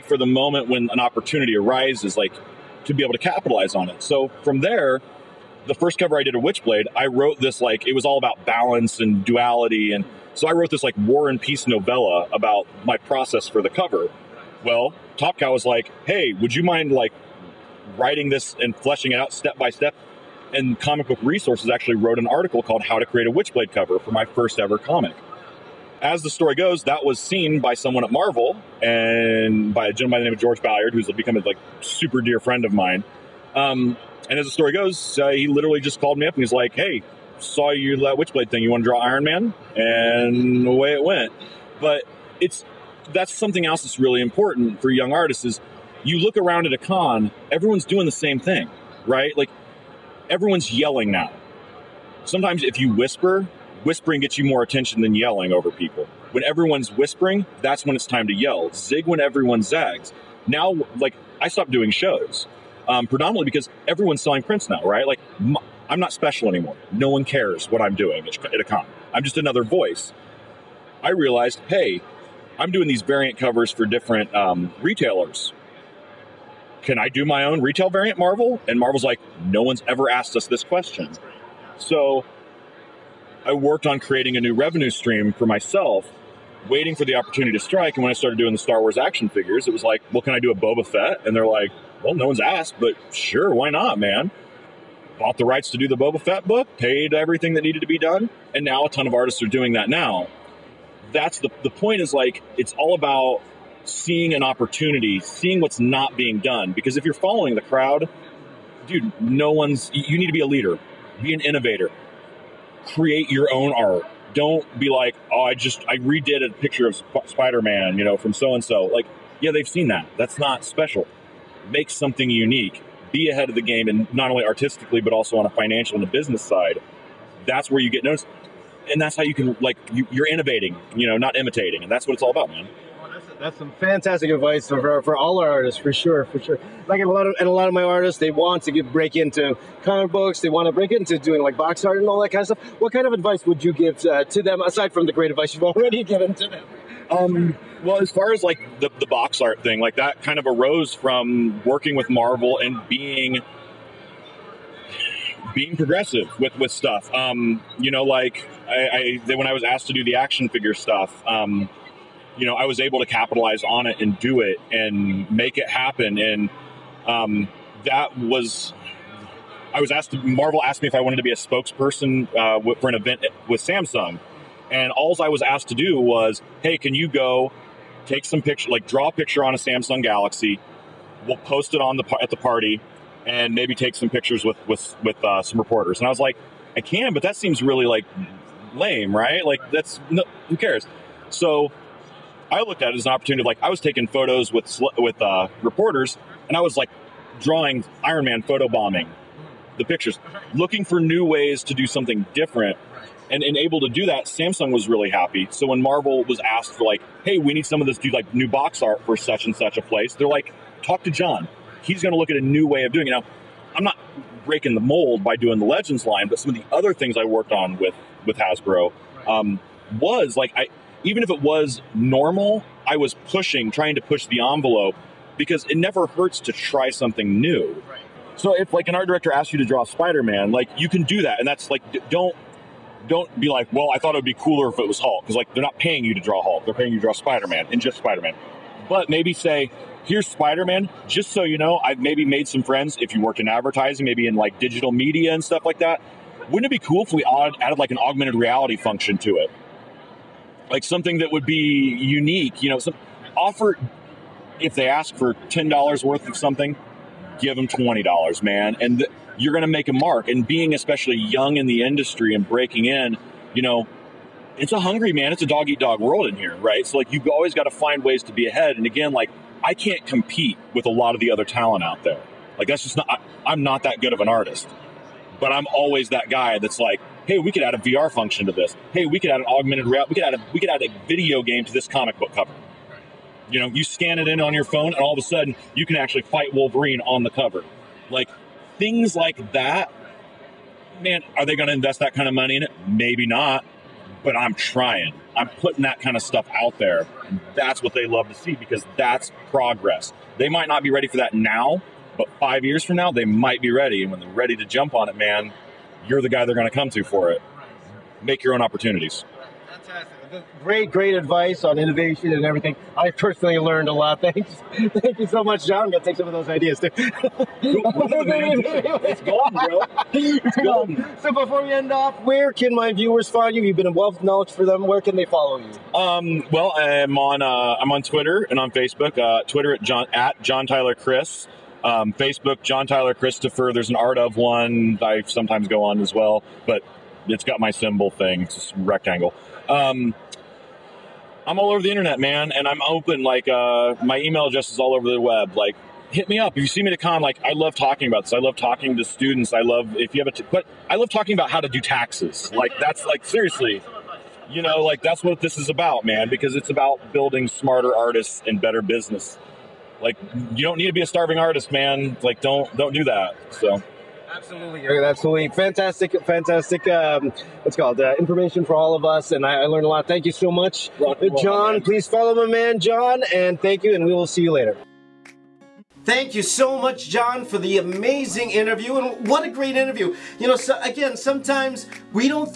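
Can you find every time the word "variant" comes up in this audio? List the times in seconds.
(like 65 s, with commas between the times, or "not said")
73 s, 77 s.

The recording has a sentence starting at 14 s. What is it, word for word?
Well, Top Cow was like, "Hey, would you mind like writing this and fleshing it out step by step.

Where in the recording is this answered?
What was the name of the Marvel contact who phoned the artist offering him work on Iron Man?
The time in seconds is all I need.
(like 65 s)
30 s.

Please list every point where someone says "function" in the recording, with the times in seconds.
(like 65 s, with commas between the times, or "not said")
248 s, 278 s.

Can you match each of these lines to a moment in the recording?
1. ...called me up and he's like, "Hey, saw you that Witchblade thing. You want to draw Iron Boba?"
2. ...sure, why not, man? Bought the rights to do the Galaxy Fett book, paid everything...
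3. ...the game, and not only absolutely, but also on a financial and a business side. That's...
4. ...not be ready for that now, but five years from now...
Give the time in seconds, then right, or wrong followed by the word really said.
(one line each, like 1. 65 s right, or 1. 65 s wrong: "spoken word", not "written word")
1. 35 s wrong: "Man", not "Boba"
2. 93 s wrong: "Boba", not "Galaxy"
3. 123 s wrong: "artistically", not "absolutely"
4. 300 s right.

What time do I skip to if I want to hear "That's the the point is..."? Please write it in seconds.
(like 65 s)
101 s.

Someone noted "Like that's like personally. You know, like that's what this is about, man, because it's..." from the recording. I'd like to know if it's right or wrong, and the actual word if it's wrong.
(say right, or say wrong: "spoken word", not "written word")
wrong: "seriously", not "personally".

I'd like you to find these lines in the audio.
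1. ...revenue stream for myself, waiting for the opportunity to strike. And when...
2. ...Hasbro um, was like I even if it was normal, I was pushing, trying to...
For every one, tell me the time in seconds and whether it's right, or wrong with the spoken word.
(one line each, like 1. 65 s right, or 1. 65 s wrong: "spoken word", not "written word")
1. 84 s right
2. 218 s right.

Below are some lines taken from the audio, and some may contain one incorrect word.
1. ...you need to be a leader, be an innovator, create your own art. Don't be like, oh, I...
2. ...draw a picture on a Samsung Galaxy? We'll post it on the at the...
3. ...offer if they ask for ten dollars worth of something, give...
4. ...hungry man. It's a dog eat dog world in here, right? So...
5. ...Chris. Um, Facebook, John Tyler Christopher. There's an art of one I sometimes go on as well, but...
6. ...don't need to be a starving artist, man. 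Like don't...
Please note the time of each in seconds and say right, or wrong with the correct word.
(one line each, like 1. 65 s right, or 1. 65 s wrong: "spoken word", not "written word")
1. 109 s right
2. 178 s right
3. 253 s right
4. 264 s right
5. 330 s right
6. 360 s right.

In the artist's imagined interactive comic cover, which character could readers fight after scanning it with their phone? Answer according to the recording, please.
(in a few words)
Wolverine.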